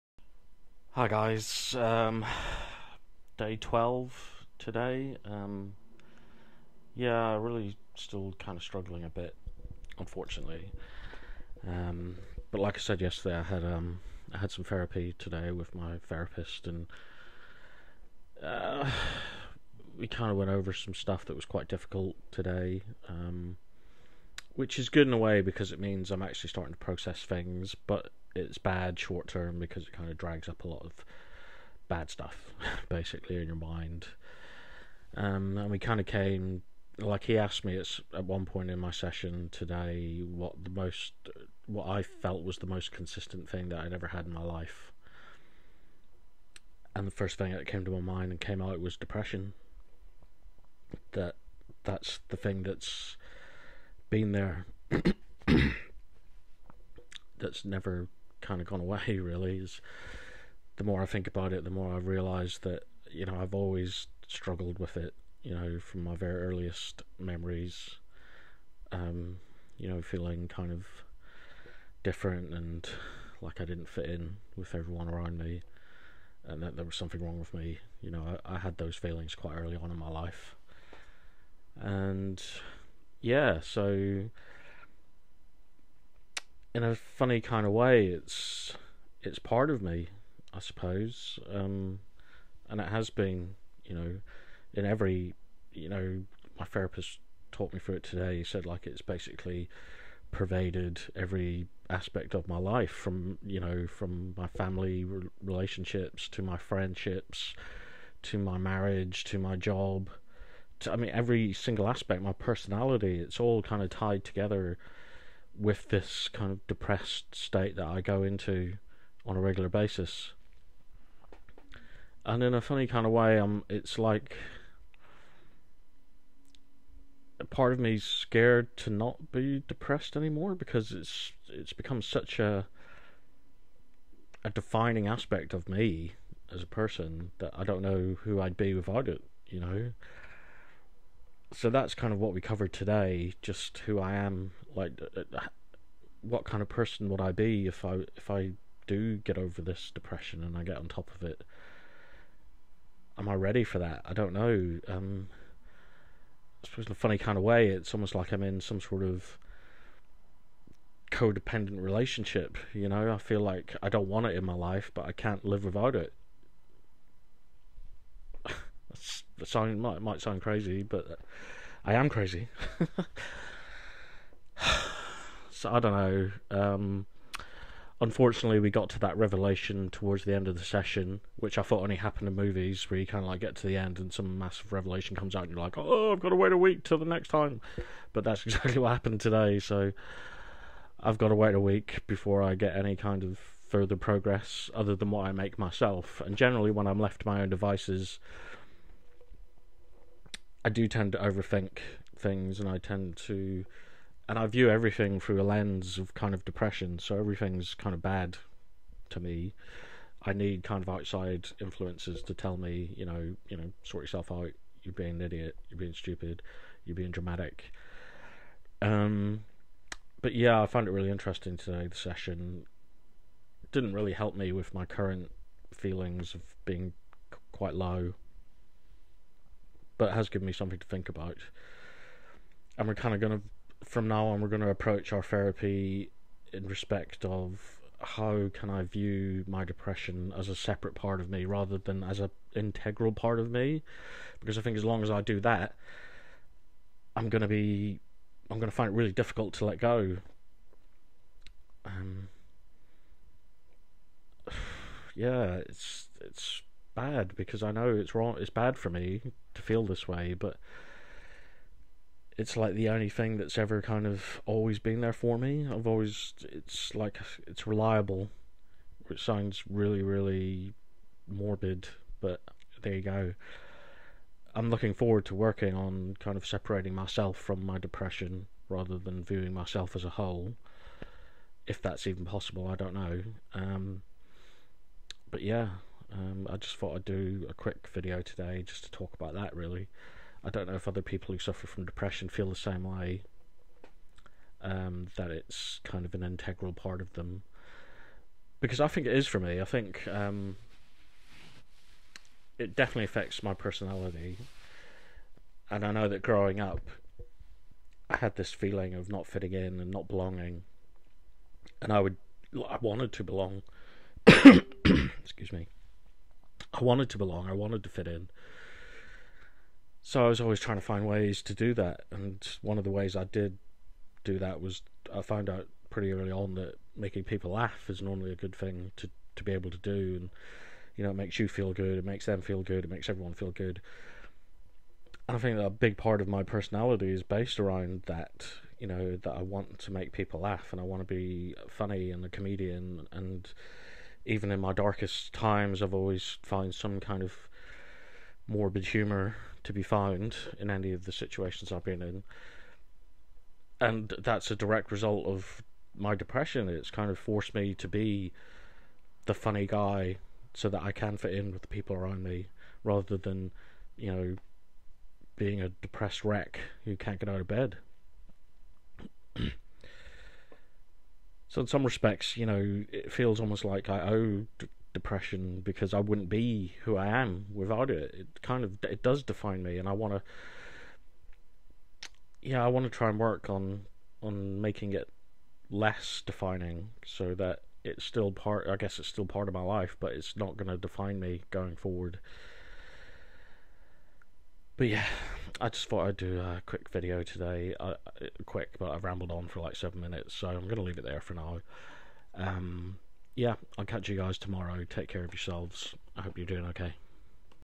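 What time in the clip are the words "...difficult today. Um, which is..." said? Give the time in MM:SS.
00:21.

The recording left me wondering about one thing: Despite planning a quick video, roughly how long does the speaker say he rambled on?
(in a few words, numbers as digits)
7 minutes.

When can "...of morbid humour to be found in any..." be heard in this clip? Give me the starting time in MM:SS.
05:47.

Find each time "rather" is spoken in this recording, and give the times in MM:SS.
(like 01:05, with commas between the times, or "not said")
04:01, 04:38, 06:02.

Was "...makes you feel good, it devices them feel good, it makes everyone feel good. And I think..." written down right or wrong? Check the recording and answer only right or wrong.
wrong.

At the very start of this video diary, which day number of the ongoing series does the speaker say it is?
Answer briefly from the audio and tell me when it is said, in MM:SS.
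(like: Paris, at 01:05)
12, at 00:03.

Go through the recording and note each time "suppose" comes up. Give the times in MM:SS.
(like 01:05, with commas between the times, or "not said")
01:30, 02:36.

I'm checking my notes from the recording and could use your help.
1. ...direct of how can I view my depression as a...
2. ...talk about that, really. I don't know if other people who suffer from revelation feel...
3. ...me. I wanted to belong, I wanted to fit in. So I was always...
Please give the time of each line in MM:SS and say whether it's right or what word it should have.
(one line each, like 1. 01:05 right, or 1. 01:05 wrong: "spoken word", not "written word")
1. 03:56 wrong: "respect", not "direct"
2. 04:48 wrong: "depression", not "revelation"
3. 05:15 right.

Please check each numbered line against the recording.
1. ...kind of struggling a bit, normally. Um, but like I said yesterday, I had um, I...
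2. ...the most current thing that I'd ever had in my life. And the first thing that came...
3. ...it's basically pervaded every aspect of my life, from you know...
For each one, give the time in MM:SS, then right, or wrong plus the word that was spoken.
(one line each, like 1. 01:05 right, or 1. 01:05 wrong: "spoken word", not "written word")
1. 00:08 wrong: "unfortunately", not "normally"
2. 00:42 wrong: "consistent", not "current"
3. 01:38 right.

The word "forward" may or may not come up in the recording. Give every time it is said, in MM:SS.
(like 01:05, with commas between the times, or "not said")
04:34, 06:31.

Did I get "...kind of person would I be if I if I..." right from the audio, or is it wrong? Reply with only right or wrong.
right.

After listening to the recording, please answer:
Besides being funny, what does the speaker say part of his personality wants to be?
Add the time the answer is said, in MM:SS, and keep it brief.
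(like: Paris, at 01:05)
a comedian, at 05:42.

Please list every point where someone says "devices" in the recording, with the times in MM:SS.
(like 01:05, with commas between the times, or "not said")
03:17.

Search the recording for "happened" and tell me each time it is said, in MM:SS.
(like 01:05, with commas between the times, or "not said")
03:01, 03:08.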